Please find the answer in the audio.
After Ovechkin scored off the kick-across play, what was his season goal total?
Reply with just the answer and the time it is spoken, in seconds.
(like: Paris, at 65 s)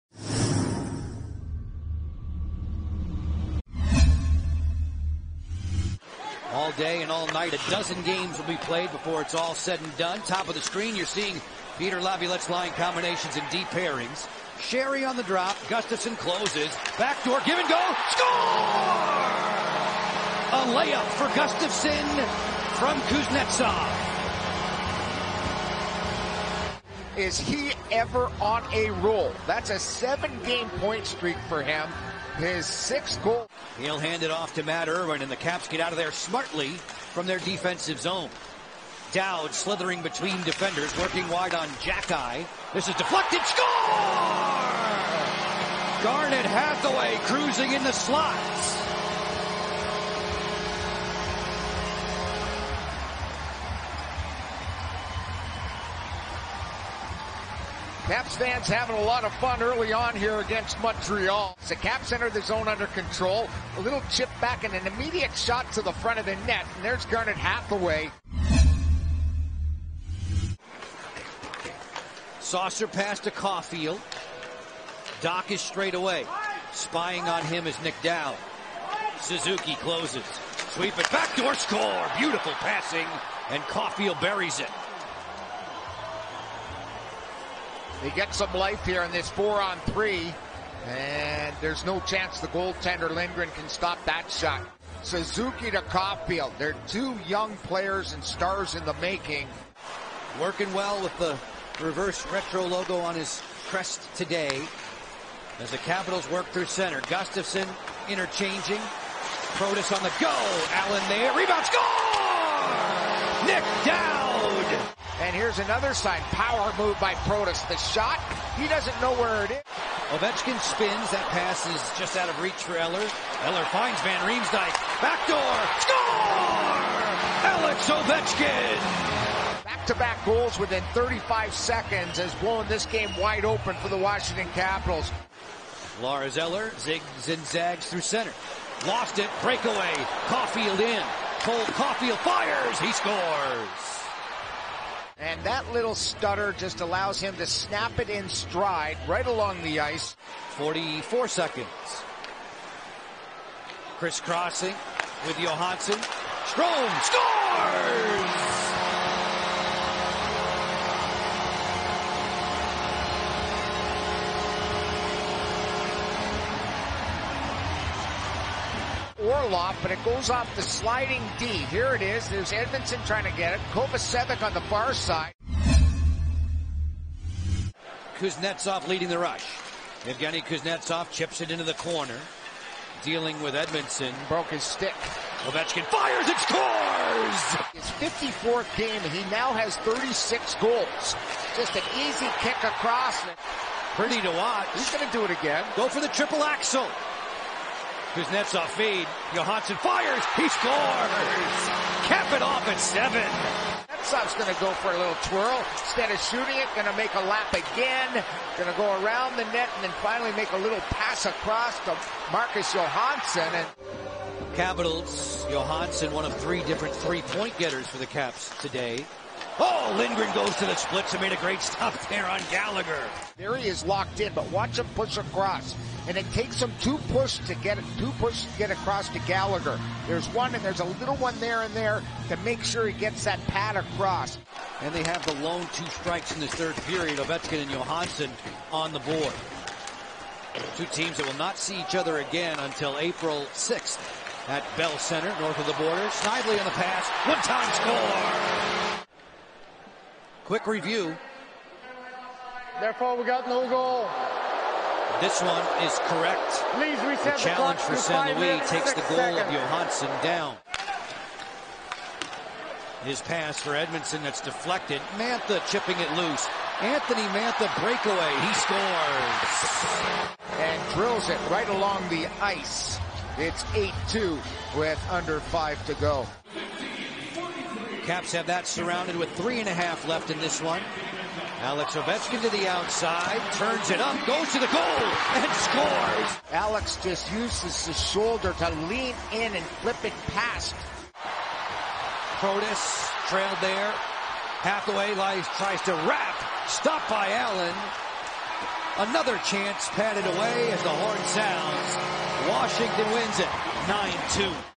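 36, at 189 s.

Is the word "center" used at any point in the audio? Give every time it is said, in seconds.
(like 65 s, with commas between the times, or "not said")
106 s, 138 s, 244 s.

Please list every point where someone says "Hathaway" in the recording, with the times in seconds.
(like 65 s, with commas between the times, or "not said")
46 s, 67 s, 294 s.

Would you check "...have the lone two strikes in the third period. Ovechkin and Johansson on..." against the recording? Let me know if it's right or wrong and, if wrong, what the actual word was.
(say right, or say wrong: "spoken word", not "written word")
right.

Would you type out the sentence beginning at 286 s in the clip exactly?
Alex just uses his shoulder to lean in and flip it past.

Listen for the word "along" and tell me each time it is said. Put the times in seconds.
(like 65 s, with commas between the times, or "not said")
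149 s, 271 s.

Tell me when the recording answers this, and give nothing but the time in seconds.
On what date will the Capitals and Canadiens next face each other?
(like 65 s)
242 s.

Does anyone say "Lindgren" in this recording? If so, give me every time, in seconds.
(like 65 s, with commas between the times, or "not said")
93 s, 219 s.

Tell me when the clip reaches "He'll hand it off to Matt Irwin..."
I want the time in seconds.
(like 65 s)
33 s.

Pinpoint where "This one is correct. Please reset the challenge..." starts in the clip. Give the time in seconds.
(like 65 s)
255 s.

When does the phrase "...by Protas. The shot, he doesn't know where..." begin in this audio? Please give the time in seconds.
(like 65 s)
116 s.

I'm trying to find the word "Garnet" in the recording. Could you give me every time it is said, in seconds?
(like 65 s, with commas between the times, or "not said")
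46 s, 67 s.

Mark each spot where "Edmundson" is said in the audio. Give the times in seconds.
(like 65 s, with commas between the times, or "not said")
172 s, 183 s, 263 s.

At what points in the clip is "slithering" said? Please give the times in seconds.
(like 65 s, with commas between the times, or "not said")
39 s.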